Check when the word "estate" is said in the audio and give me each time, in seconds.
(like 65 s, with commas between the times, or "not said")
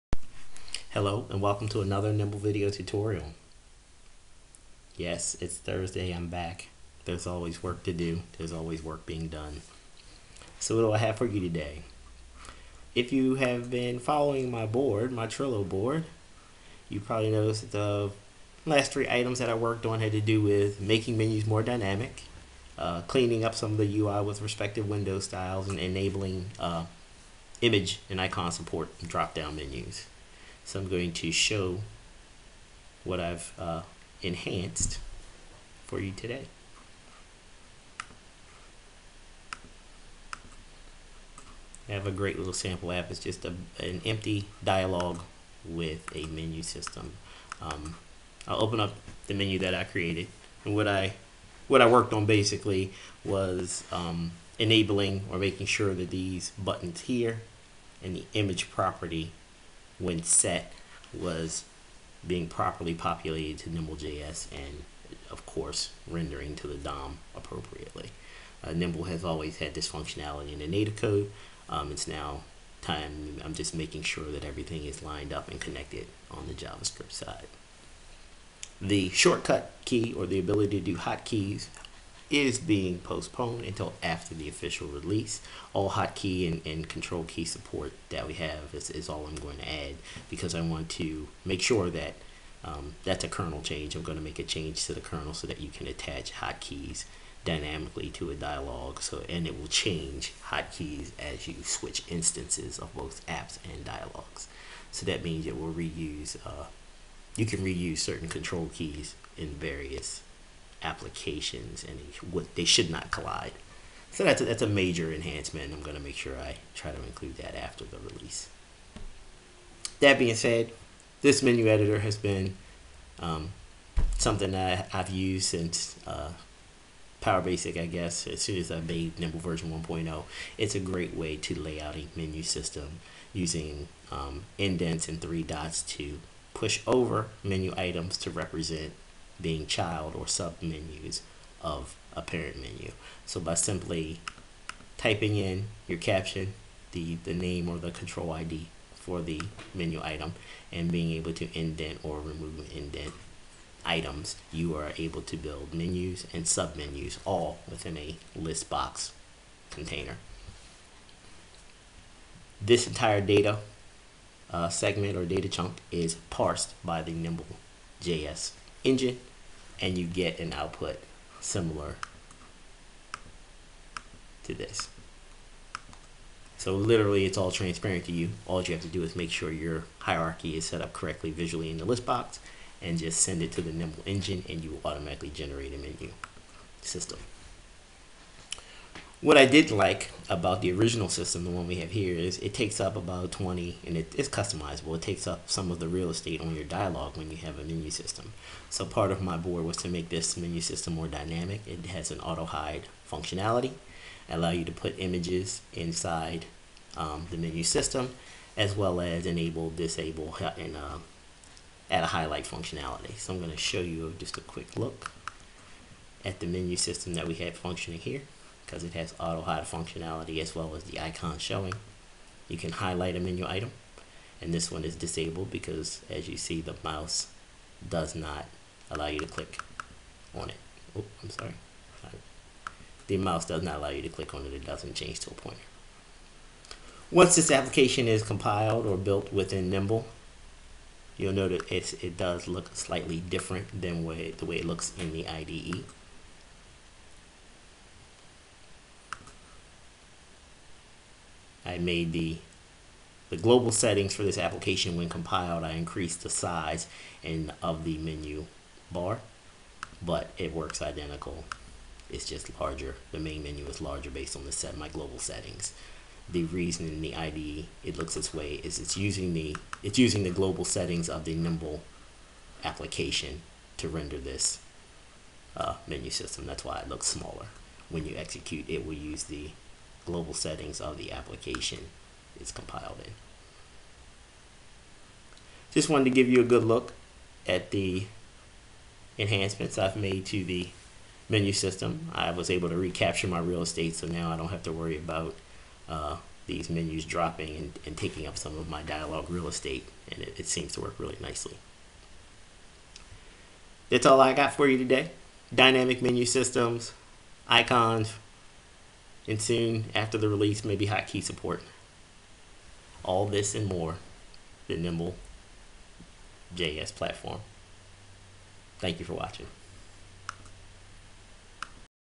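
196 s, 293 s, 299 s.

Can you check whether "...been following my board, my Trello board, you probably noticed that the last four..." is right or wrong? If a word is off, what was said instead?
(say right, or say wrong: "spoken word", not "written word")
wrong: "three", not "four".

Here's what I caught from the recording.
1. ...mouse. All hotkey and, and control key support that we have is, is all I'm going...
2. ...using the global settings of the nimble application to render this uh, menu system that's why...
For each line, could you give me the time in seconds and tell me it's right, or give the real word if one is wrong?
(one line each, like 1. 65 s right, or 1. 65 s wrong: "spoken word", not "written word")
1. 84 s wrong: "release", not "mouse"
2. 269 s right.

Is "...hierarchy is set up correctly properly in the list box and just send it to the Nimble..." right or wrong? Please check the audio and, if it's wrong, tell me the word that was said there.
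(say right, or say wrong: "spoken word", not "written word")
wrong: "visually", not "properly".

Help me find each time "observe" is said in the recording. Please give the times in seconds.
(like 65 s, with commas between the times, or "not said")
not said.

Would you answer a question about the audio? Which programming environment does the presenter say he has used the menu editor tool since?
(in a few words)
Power Basic.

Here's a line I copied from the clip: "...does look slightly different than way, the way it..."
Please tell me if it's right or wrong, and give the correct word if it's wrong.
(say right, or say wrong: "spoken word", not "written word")
right.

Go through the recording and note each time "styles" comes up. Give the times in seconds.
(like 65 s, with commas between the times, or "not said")
25 s.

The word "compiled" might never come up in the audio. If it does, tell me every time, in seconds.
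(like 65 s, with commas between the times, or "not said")
238 s, 255 s, 282 s.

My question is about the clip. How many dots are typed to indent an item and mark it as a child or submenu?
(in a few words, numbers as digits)
3.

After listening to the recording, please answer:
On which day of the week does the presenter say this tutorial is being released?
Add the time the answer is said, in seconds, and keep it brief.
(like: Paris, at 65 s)
Thursday, at 5 s.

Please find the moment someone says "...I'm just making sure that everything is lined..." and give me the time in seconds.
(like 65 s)
73 s.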